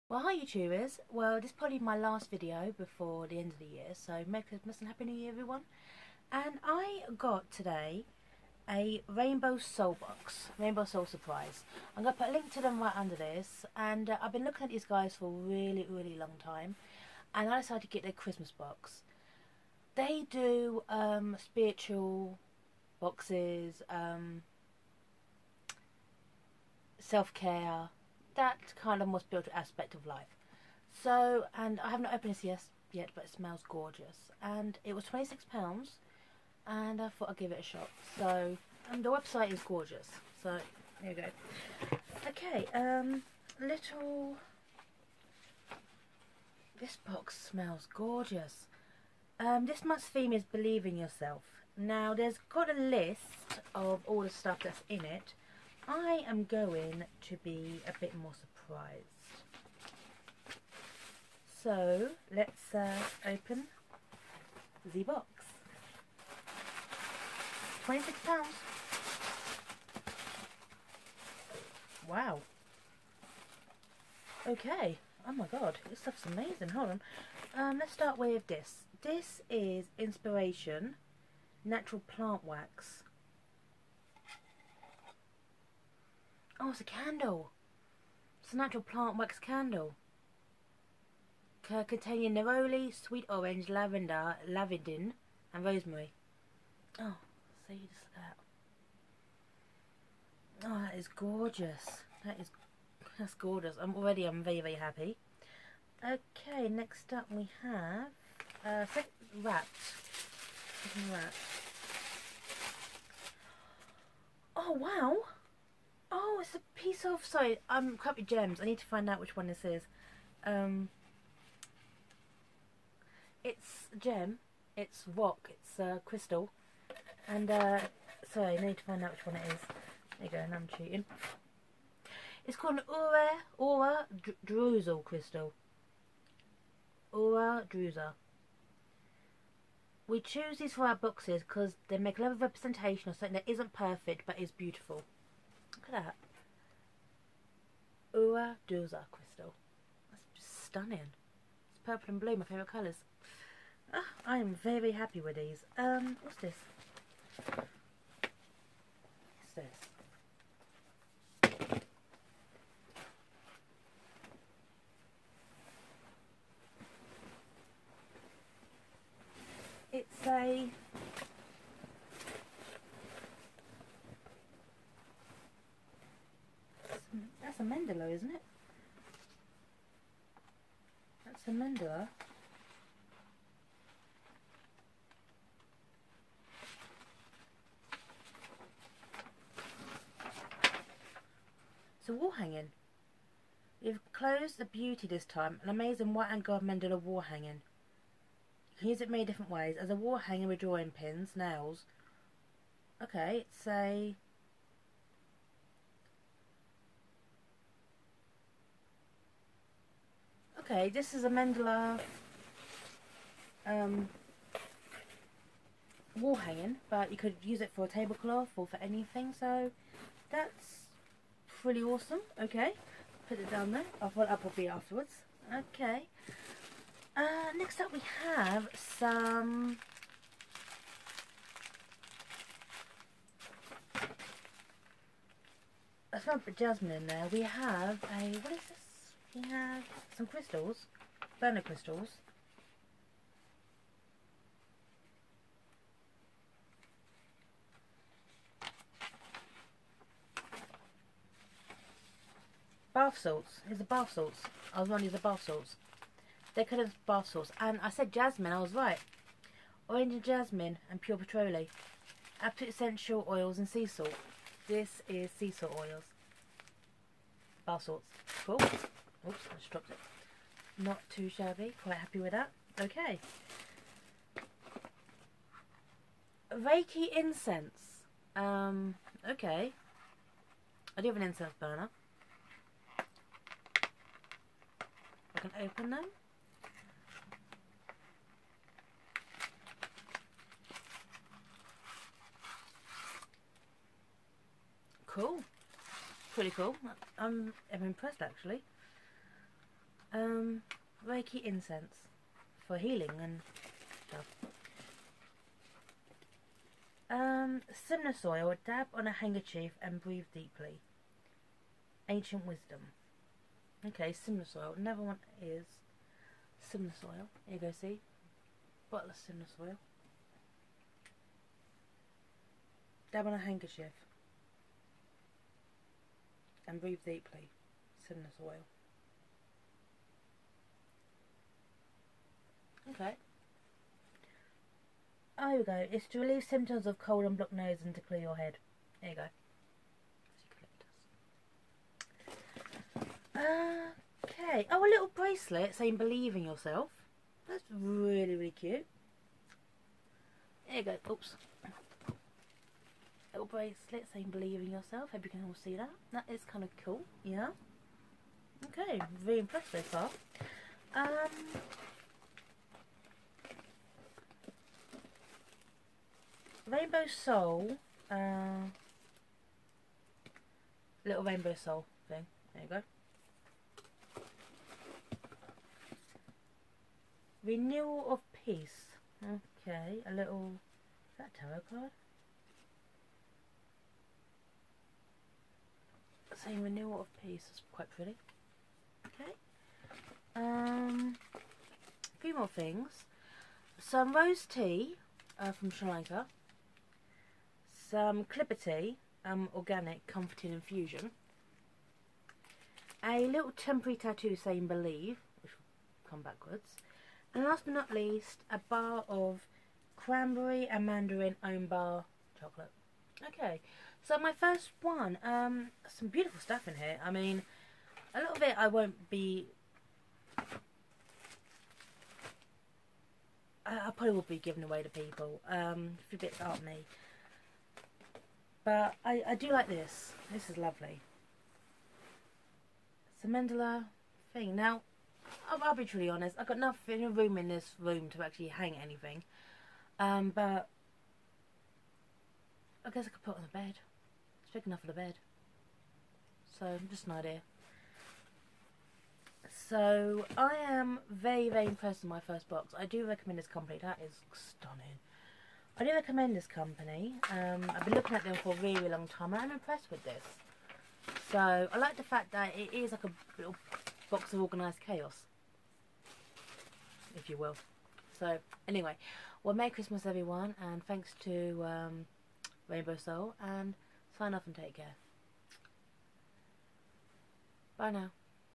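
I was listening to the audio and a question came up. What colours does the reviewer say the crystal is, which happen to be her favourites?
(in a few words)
Purple and blue.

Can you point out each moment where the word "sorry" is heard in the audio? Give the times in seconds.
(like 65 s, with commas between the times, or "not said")
117 s, 128 s.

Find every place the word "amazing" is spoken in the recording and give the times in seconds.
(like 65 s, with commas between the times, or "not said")
76 s, 195 s.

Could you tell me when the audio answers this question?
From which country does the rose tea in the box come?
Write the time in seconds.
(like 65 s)
395 s.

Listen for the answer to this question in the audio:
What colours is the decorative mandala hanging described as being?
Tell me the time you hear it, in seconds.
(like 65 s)
196 s.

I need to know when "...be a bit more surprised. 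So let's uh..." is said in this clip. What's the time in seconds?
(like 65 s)
57 s.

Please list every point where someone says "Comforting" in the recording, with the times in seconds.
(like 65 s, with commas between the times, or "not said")
400 s.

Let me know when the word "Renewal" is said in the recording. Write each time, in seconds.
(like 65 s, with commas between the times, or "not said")
377 s, 386 s.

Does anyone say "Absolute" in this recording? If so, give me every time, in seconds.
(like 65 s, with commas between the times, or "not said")
262 s.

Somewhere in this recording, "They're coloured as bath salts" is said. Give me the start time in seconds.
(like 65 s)
256 s.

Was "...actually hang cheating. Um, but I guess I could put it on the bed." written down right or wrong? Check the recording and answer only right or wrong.
wrong.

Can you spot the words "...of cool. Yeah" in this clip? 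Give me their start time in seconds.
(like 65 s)
356 s.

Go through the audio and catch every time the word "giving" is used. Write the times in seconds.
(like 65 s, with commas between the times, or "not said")
424 s.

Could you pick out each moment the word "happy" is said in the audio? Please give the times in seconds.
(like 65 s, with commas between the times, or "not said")
4 s, 104 s, 154 s, 271 s.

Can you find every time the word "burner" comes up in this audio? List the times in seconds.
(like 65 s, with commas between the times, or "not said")
241 s, 281 s.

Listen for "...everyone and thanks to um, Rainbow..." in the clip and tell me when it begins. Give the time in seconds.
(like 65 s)
470 s.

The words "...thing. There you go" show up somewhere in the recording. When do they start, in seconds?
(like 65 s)
372 s.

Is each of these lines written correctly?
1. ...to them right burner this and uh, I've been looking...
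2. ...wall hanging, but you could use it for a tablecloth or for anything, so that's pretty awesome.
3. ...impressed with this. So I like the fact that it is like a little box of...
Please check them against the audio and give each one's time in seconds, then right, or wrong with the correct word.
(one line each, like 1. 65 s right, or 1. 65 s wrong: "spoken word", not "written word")
1. 12 s wrong: "under", not "burner"
2. 216 s right
3. 459 s right.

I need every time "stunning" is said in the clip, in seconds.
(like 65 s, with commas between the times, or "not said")
150 s, 454 s.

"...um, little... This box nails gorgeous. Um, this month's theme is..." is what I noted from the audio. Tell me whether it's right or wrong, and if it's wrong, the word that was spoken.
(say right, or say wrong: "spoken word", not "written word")
wrong: "smells", not "nails".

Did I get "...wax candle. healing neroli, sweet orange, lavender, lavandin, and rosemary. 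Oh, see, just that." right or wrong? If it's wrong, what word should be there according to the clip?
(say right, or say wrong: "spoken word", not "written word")
wrong: "containing", not "healing".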